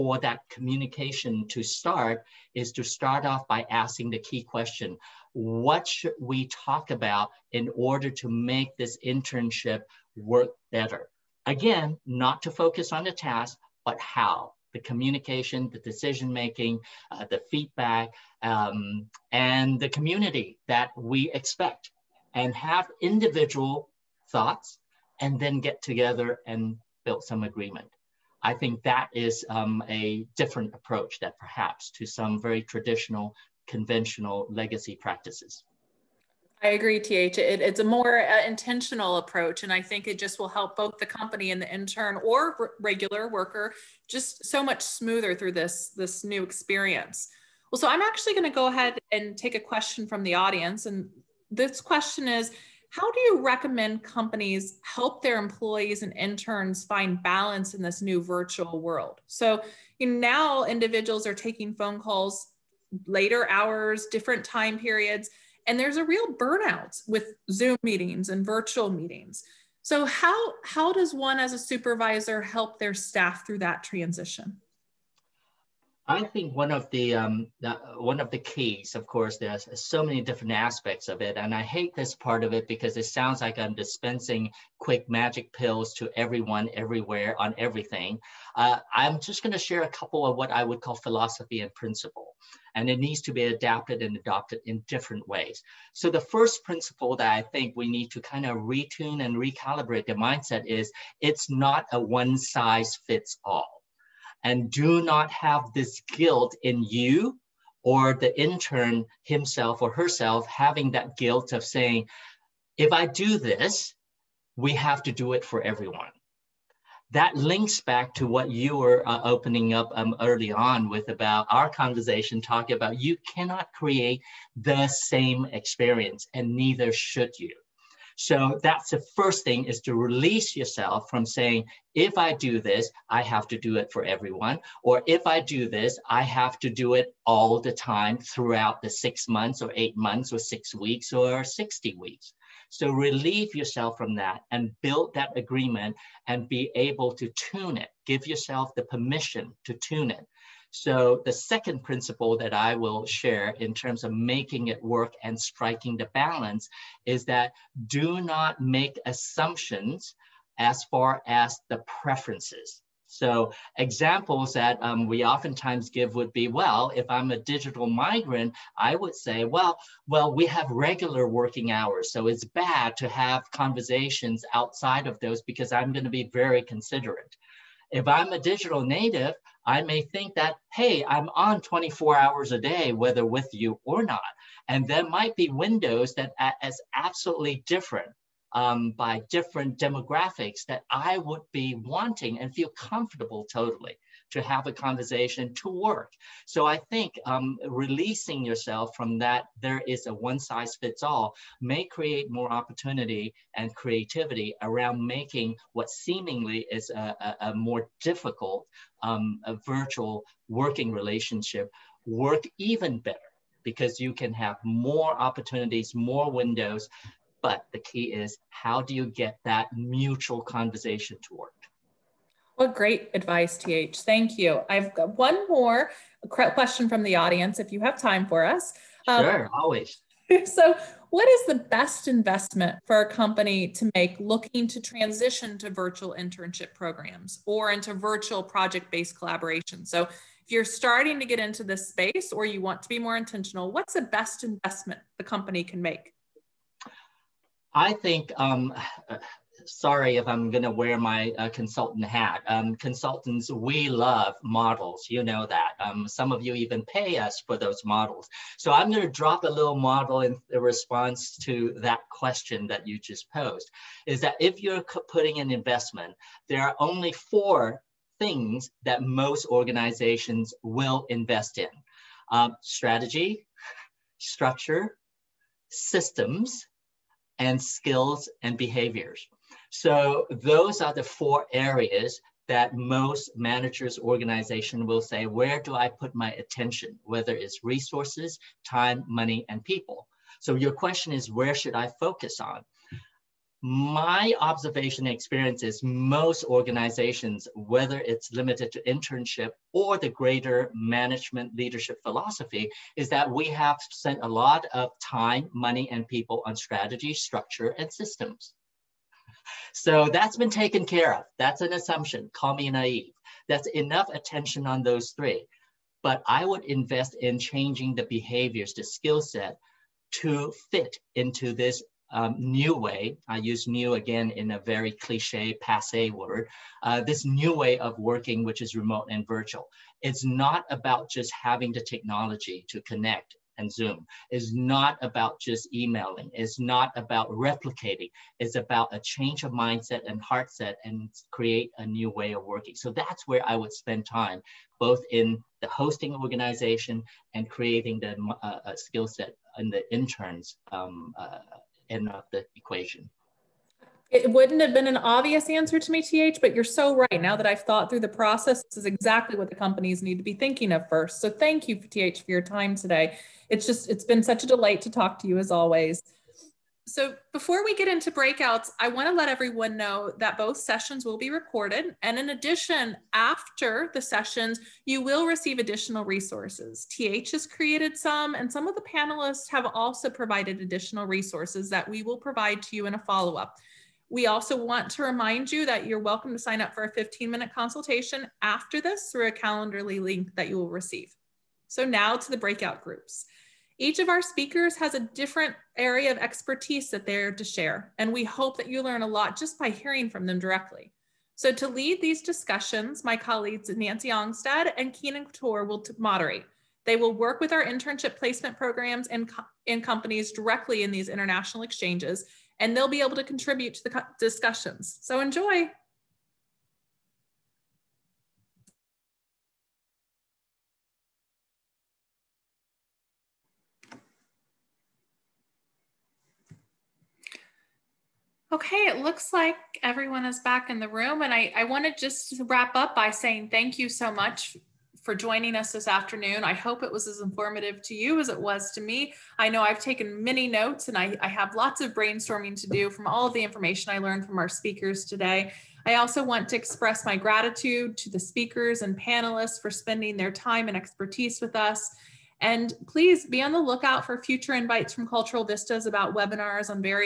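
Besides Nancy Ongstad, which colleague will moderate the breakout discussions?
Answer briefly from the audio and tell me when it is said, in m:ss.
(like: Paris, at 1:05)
Keenan Couture, at 6:44.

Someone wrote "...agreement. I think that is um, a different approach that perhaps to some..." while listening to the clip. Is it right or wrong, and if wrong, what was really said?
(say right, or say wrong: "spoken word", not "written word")
right.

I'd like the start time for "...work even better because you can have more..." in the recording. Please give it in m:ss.
3:32.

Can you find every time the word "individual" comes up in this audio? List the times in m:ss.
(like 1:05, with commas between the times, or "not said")
0:22, 1:00.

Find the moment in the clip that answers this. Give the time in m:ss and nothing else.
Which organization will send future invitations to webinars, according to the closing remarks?
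7:35.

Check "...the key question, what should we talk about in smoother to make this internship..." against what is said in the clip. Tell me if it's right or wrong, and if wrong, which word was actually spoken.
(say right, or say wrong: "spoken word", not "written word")
wrong: "order", not "smoother".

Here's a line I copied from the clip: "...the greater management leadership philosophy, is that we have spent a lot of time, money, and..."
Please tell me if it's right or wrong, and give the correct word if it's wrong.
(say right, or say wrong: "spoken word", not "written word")
right.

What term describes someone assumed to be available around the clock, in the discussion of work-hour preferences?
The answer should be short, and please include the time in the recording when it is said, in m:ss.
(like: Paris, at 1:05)
digital native, at 2:58.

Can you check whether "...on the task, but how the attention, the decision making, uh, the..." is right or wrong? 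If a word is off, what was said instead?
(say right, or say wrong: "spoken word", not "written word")
wrong: "communication", not "attention".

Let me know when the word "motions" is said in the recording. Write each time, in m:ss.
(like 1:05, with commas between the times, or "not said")
not said.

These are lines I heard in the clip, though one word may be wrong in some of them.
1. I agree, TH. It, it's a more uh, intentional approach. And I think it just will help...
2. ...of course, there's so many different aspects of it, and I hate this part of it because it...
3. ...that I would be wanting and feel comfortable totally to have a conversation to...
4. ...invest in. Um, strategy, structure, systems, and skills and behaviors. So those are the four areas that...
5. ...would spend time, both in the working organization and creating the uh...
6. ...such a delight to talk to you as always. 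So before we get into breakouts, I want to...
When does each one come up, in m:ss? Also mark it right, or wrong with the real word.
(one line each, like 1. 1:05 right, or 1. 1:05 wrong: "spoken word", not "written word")
1. 0:36 right
2. 1:18 right
3. 3:10 right
4. 4:31 right
5. 5:43 wrong: "hosting", not "working"
6. 6:04 right.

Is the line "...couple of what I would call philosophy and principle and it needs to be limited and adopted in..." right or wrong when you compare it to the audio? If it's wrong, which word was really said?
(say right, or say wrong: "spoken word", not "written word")
wrong: "adapted", not "limited".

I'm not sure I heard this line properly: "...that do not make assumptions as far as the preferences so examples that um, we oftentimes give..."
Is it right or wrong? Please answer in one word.
right.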